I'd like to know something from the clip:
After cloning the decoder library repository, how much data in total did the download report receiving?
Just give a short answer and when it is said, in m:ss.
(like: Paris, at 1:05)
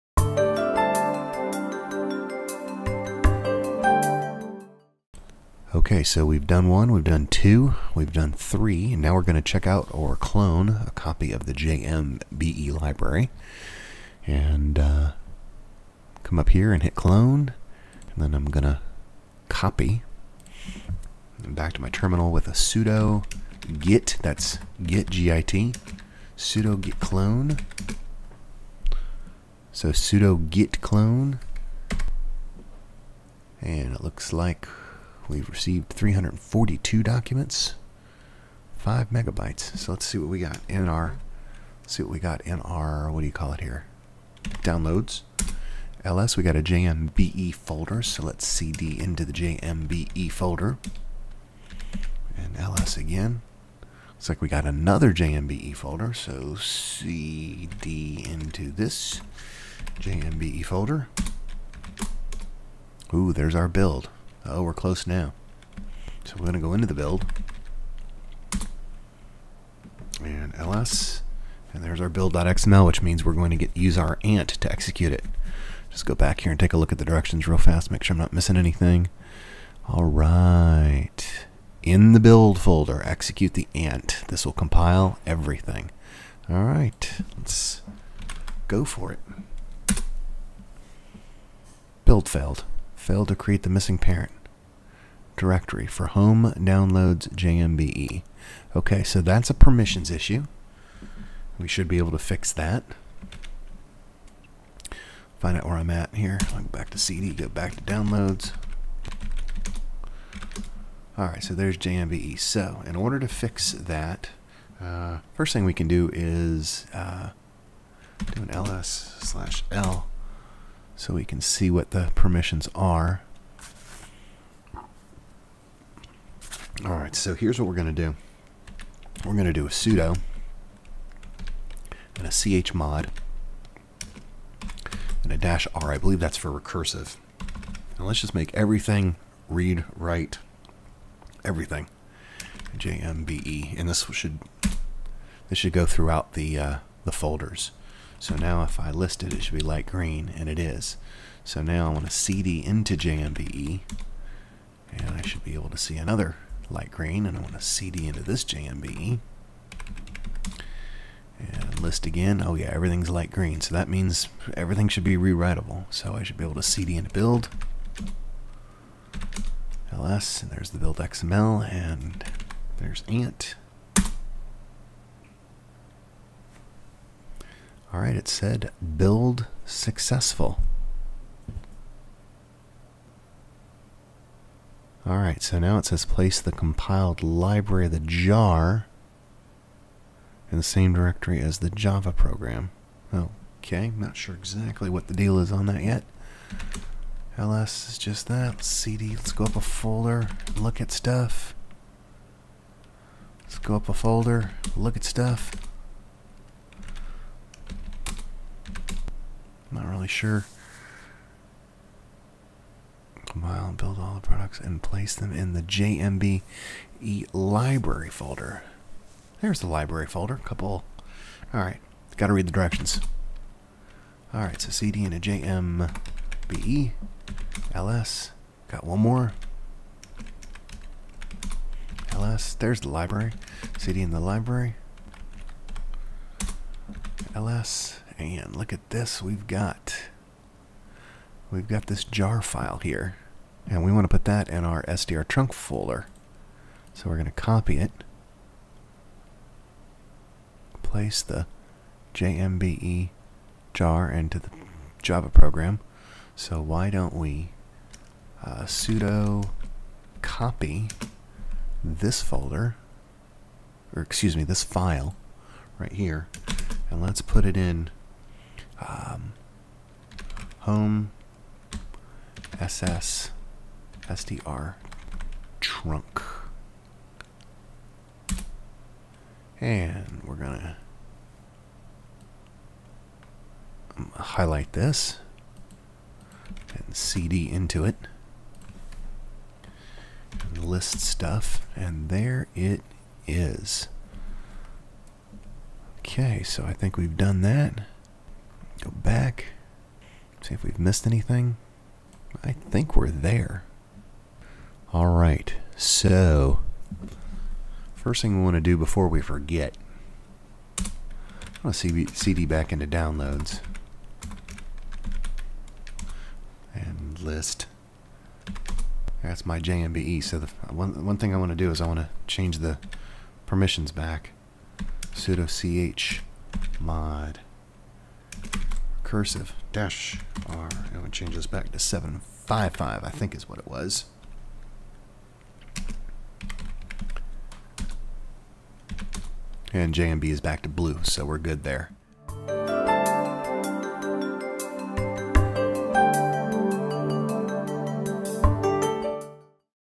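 5 megabytes, at 0:38.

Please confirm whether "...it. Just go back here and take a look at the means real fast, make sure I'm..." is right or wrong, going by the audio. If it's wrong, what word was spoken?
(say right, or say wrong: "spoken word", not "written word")
wrong: "directions", not "means".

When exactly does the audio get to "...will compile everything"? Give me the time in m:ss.
1:24.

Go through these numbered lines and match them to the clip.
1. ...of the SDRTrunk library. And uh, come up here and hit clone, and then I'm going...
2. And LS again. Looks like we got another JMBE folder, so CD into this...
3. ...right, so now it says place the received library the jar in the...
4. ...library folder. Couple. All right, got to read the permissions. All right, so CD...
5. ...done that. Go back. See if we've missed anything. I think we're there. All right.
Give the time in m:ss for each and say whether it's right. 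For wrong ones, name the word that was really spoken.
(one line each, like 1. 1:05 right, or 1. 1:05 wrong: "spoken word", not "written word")
1. 0:11 wrong: "JMBE", not "SDRTrunk"
2. 0:52 right
3. 3:05 wrong: "compiled", not "received"
4. 3:39 wrong: "directions", not "permissions"
5. 4:57 right.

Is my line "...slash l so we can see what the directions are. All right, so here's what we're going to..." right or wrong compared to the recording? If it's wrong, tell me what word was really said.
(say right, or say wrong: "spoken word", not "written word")
wrong: "permissions", not "directions".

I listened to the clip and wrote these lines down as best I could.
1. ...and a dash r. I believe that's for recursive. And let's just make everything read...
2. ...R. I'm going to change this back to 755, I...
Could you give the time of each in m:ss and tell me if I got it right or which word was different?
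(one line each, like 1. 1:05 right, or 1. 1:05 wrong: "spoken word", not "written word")
1. 2:15 right
2. 5:30 right.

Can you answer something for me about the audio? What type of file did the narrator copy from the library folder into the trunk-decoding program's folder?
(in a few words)
jar file.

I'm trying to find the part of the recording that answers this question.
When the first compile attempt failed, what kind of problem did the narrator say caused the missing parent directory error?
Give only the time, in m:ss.
1:39.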